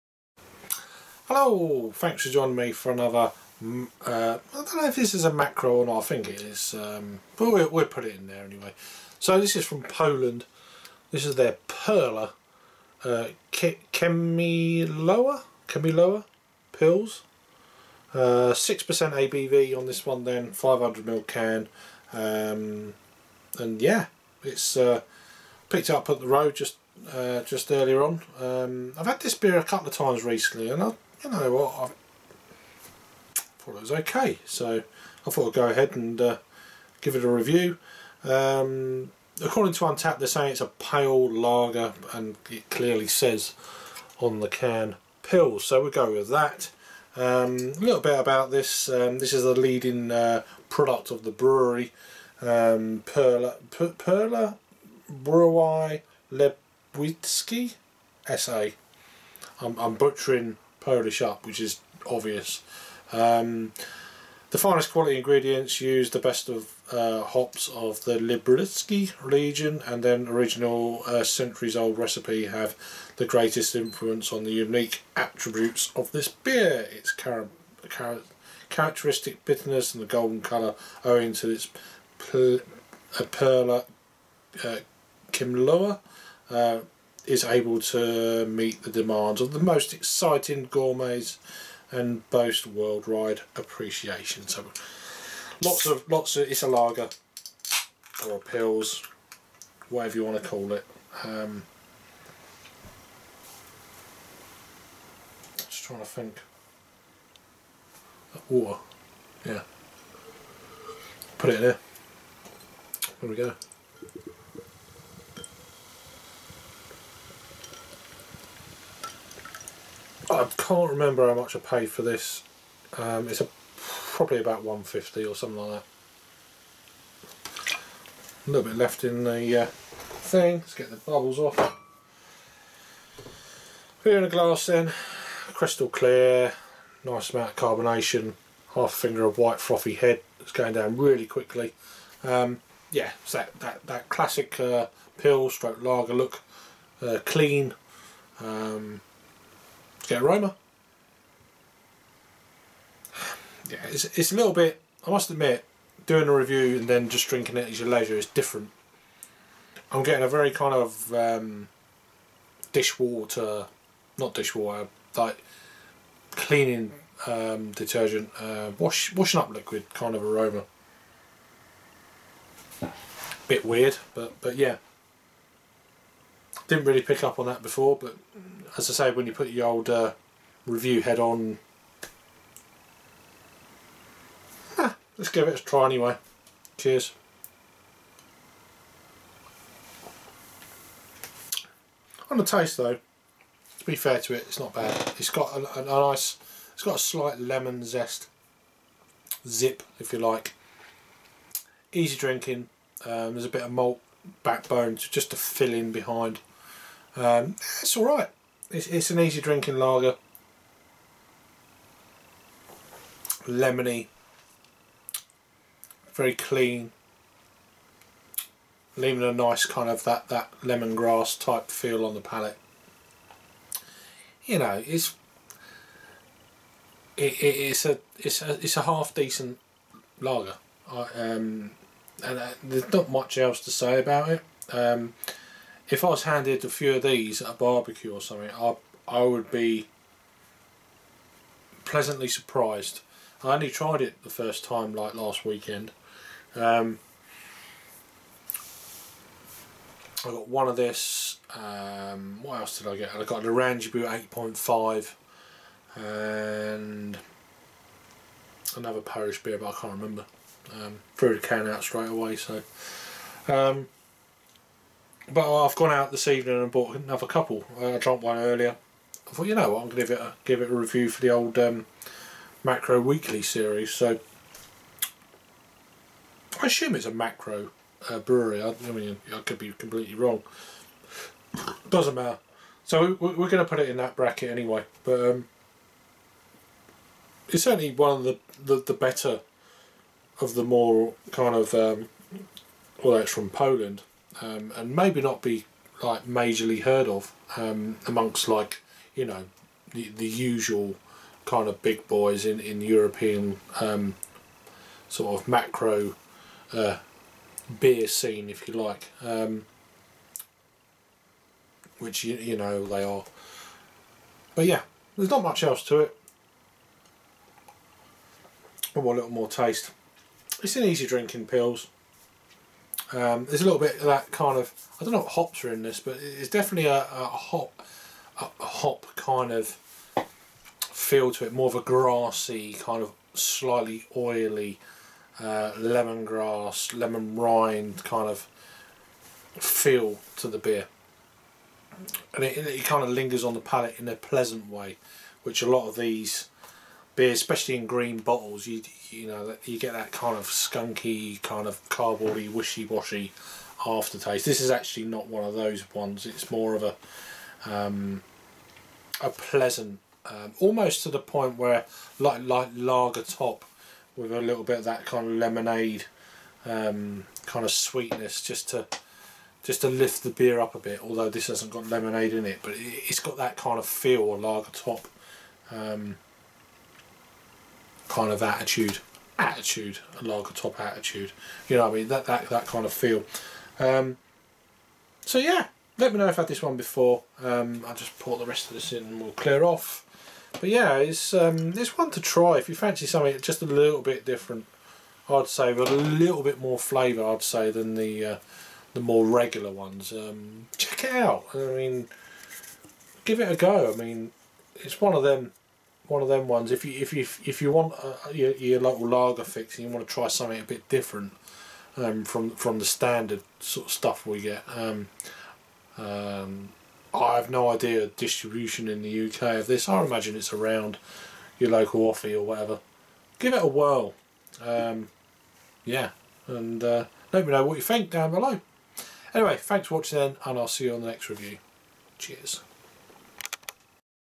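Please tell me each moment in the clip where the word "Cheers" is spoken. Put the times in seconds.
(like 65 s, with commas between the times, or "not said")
186 s, 432 s.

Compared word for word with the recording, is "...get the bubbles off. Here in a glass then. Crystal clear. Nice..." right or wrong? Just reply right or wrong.
right.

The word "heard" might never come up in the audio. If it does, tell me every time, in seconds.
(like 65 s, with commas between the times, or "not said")
296 s.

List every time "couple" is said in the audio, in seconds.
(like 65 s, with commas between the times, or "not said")
29 s, 267 s.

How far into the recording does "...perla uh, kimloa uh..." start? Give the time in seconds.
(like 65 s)
83 s.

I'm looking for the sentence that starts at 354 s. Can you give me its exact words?
This is actually not one of those ones.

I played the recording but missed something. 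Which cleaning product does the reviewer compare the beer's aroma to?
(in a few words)
washing up liquid.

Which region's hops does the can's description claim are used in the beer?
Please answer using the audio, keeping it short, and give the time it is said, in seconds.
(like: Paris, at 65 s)
Liberec, at 68 s.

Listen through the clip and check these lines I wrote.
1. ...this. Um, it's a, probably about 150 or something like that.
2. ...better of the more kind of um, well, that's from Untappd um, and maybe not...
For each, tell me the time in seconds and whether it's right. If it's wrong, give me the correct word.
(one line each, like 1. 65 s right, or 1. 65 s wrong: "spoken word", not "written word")
1. 122 s right
2. 288 s wrong: "Poland", not "Untappd".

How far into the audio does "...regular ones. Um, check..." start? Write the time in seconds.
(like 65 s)
399 s.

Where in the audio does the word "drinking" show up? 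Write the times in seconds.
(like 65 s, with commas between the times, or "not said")
157 s, 202 s, 209 s, 321 s.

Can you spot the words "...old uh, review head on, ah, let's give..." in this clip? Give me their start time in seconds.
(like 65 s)
179 s.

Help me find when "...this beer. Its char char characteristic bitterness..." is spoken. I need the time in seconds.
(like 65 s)
76 s.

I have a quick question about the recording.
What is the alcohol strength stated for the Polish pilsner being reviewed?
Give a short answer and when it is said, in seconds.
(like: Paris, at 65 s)
6%, at 18 s.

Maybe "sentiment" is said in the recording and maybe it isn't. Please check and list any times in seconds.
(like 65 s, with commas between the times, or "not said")
not said.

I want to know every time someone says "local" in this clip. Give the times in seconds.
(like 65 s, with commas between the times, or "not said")
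408 s, 421 s.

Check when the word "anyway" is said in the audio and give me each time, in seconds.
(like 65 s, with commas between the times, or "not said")
8 s, 185 s, 284 s, 429 s.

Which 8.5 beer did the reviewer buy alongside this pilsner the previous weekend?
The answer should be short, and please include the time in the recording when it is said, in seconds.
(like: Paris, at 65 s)
Oranjeboom, at 253 s.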